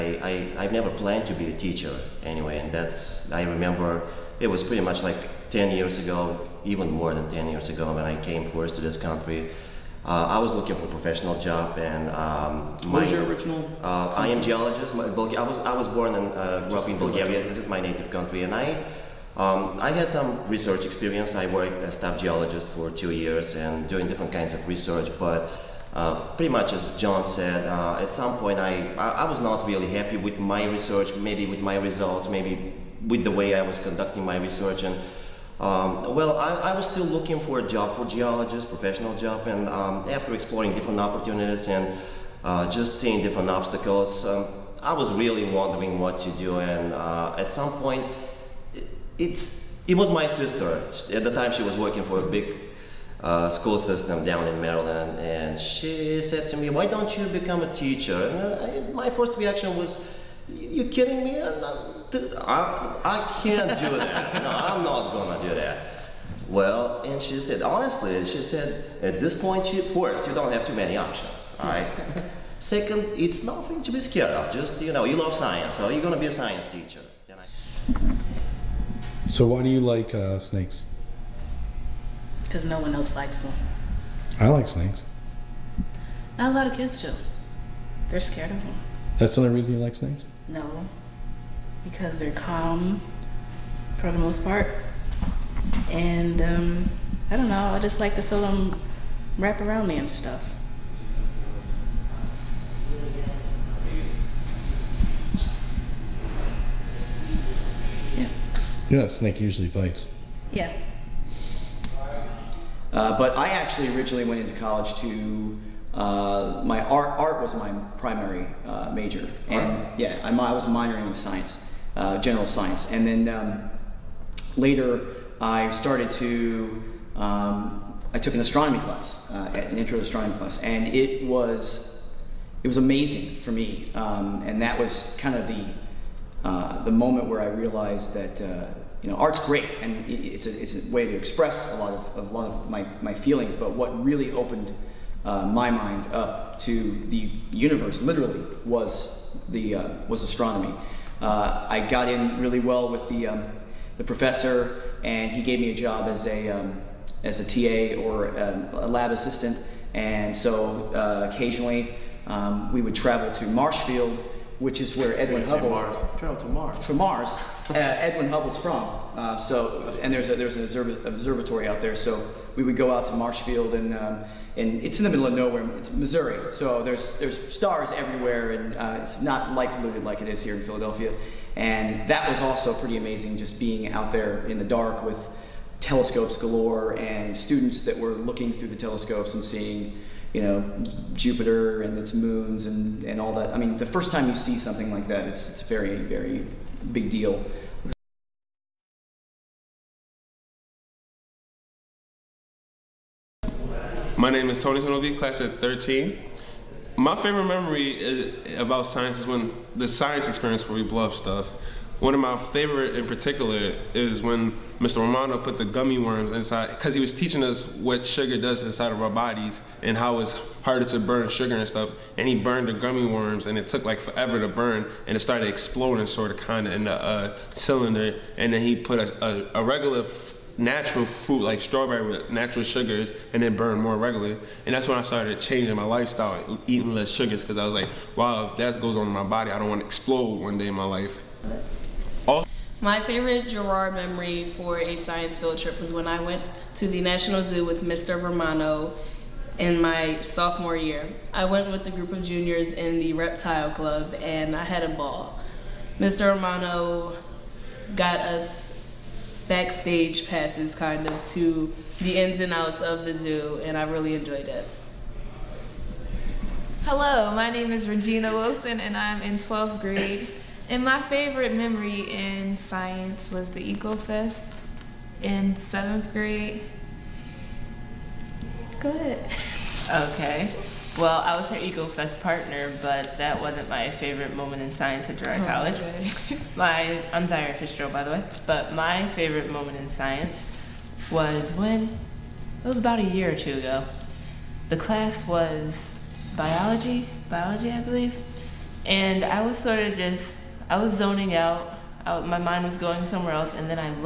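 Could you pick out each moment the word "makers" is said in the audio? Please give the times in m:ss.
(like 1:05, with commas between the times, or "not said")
not said.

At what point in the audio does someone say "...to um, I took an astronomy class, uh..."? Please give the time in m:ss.
2:06.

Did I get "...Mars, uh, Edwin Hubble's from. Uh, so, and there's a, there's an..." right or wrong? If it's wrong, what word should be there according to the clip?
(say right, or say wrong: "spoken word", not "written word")
right.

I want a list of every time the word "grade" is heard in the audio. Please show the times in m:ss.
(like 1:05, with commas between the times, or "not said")
4:29, 4:36.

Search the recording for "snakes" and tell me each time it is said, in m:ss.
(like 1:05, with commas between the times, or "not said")
1:20, 1:24, 1:29, 1:49.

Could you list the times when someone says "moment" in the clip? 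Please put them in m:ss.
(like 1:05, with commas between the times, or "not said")
2:16, 4:44, 4:49.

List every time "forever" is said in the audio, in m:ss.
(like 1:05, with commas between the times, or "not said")
3:44.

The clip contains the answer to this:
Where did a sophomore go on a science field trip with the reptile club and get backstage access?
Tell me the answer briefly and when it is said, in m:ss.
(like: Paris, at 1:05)
National Zoo, at 4:07.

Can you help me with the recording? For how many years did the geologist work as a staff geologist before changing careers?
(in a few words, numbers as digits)
2.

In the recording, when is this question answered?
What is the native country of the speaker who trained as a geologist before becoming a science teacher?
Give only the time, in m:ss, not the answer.
0:16.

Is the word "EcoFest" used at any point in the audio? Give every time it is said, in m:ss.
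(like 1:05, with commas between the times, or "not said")
4:33, 4:41.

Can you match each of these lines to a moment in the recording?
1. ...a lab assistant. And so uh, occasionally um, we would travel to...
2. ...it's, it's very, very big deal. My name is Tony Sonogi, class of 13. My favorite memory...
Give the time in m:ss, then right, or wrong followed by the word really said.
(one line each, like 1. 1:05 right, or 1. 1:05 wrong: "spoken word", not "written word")
1. 2:38 right
2. 3:15 right.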